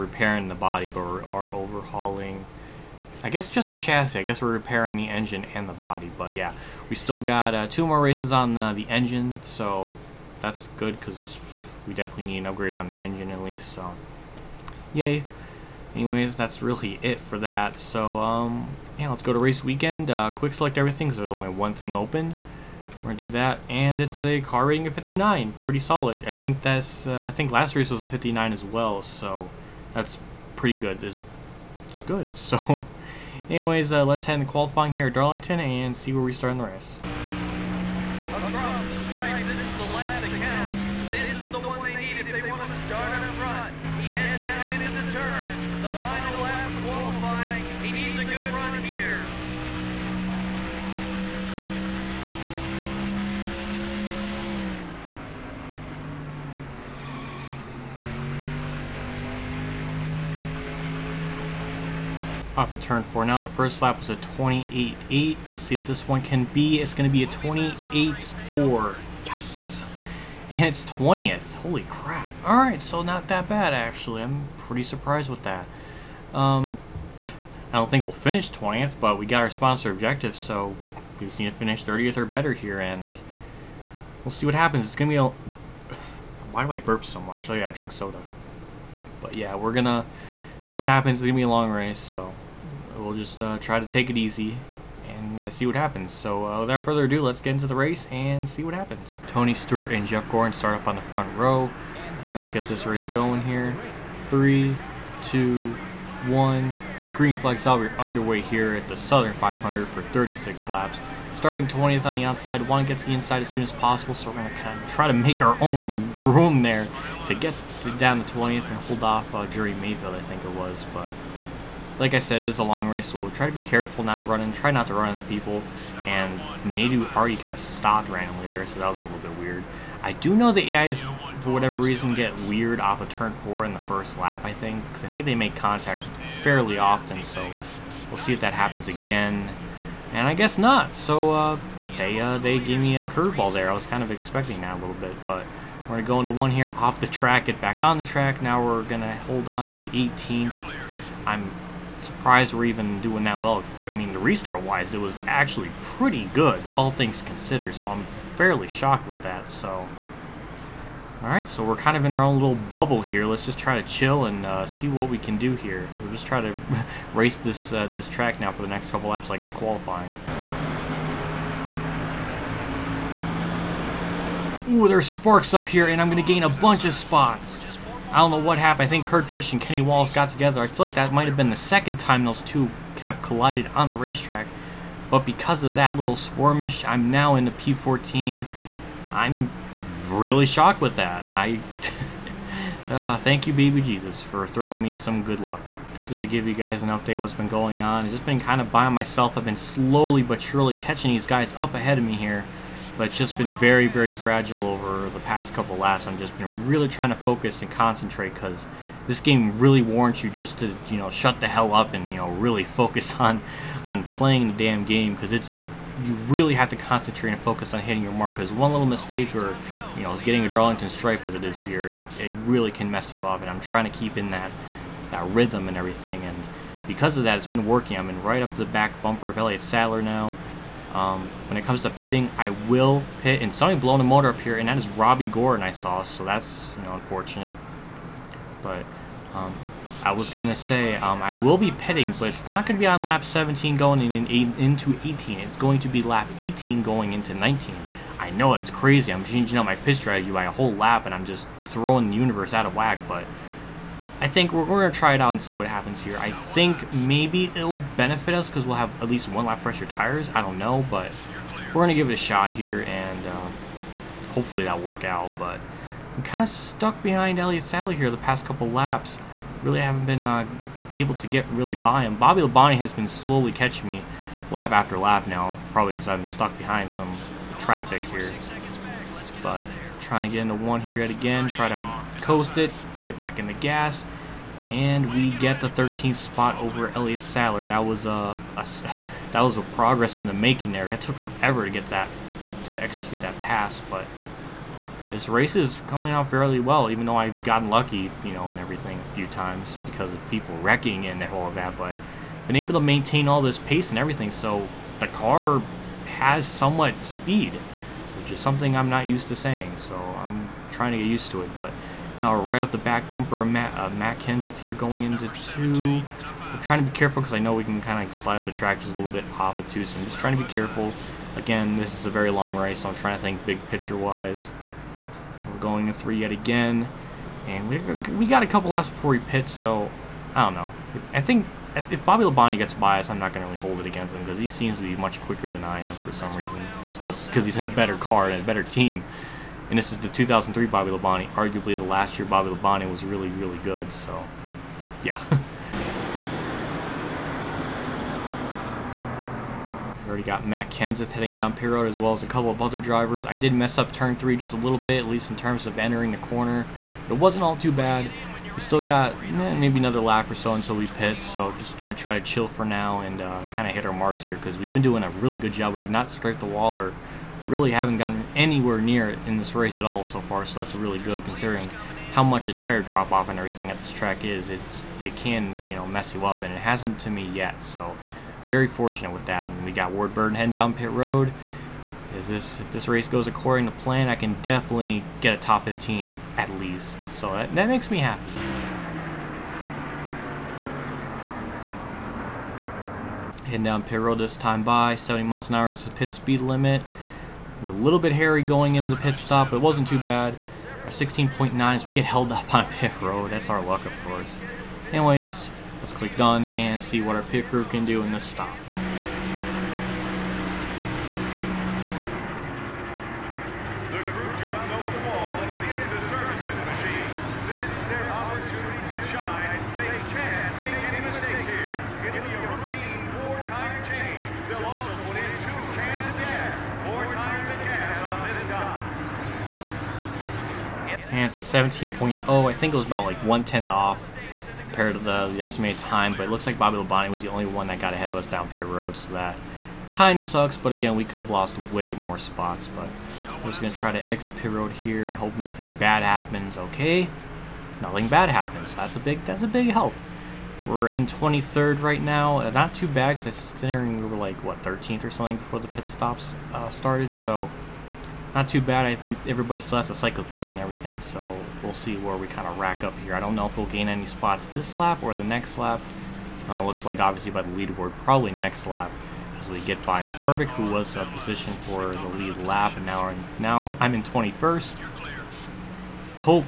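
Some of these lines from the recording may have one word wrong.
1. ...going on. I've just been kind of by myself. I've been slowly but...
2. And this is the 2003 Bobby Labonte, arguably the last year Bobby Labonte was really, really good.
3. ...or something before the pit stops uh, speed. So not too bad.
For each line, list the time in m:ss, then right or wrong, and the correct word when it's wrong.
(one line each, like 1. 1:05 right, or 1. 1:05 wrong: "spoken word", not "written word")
1. 3:17 right
2. 5:39 right
3. 7:35 wrong: "started", not "speed".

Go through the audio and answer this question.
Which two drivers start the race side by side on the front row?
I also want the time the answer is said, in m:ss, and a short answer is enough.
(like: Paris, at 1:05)
Tony Stewart and Jeff Gordon, at 1:39.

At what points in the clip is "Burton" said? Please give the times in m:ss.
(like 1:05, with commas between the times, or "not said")
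6:20.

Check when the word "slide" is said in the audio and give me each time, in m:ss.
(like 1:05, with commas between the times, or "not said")
5:18.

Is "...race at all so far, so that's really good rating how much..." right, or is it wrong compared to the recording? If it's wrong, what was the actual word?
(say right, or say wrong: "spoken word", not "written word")
wrong: "considering", not "rating".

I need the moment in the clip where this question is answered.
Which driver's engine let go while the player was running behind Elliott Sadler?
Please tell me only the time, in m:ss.
3:54.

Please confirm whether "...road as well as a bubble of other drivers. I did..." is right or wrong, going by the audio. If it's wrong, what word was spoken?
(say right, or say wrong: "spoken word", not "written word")
wrong: "couple", not "bubble".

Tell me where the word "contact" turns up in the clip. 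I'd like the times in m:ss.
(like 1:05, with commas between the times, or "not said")
2:15.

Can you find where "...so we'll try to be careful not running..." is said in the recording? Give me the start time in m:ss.
2:03.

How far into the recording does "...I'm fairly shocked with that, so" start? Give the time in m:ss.
2:37.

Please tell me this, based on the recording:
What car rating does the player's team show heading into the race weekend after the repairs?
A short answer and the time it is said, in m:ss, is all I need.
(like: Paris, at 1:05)
59, at 0:24.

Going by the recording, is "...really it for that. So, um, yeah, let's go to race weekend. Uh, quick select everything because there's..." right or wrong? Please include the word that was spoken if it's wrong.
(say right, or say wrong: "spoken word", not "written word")
right.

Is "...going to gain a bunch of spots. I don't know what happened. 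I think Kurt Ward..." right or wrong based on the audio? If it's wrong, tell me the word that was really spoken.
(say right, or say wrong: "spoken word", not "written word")
wrong: "Busch", not "Ward".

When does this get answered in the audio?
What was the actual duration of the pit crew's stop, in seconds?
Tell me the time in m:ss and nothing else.
7:11.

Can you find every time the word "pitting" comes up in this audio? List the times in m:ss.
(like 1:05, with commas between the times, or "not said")
3:51, 4:01.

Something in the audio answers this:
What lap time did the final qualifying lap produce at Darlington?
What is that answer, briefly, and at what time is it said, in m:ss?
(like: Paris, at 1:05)
28.4, at 1:07.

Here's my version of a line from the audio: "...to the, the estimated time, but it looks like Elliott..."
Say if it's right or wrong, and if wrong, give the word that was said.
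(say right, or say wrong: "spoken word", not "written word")
wrong: "Bobby", not "Elliott".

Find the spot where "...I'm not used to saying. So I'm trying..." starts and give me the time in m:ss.
5:08.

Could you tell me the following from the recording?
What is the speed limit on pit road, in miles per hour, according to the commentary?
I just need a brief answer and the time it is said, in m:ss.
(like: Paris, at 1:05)
70, at 6:34.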